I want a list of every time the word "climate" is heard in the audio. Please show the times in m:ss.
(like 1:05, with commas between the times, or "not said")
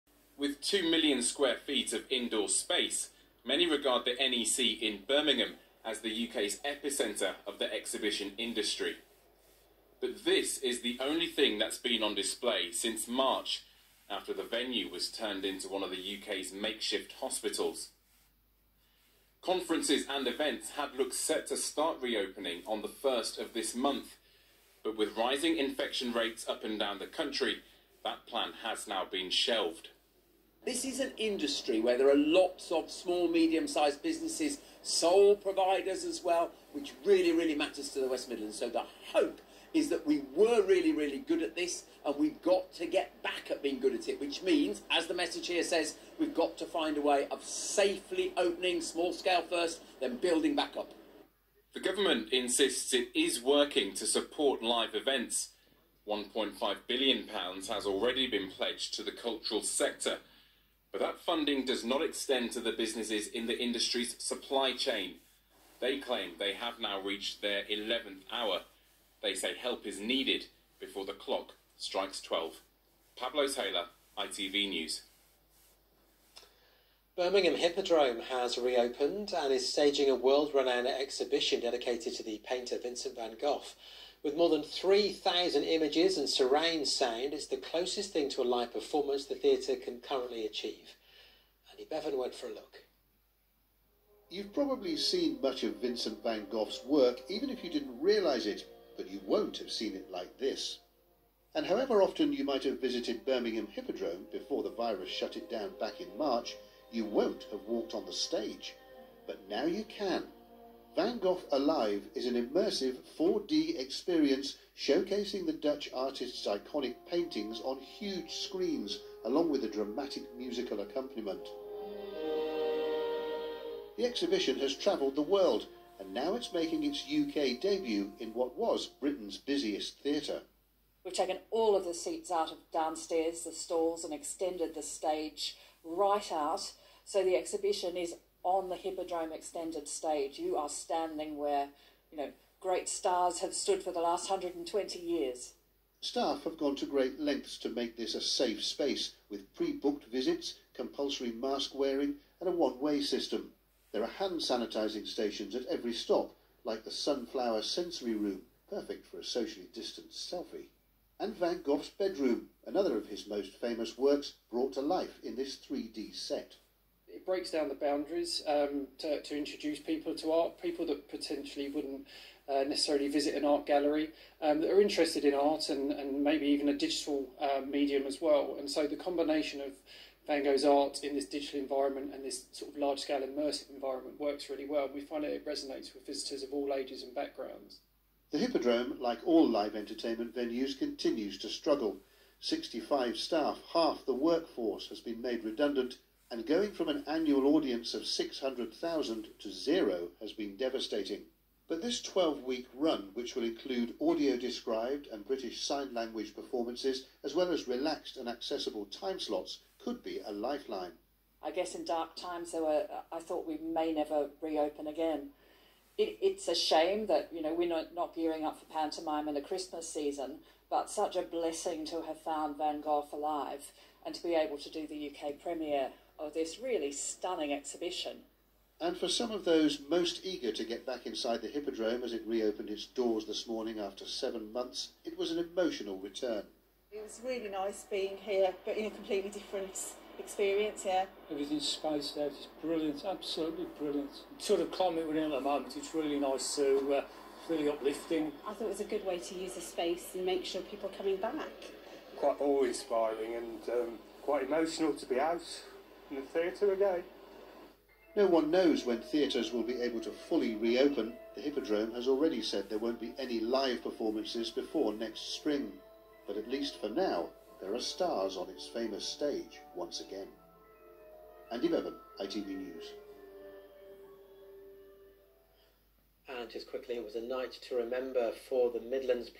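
4:04.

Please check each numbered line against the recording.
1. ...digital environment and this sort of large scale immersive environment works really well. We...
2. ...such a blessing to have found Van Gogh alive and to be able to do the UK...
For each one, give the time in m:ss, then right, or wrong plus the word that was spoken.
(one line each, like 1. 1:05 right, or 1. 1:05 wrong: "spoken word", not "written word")
1. 3:01 right
2. 3:40 right.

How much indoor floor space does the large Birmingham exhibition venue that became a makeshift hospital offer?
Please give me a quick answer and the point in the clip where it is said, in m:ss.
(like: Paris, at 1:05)
2 million square feet, at 0:00.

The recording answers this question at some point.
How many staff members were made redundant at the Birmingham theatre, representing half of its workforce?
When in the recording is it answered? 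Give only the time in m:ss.
3:12.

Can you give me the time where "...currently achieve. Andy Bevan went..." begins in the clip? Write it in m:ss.
1:29.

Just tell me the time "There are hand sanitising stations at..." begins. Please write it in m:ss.
2:33.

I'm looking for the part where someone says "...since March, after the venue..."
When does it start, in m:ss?
0:12.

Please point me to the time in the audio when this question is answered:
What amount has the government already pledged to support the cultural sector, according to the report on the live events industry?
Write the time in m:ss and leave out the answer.
0:56.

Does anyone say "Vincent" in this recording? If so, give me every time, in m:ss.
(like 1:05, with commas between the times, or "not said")
1:22, 1:35.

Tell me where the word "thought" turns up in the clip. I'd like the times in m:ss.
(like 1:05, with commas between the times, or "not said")
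3:33, 4:08.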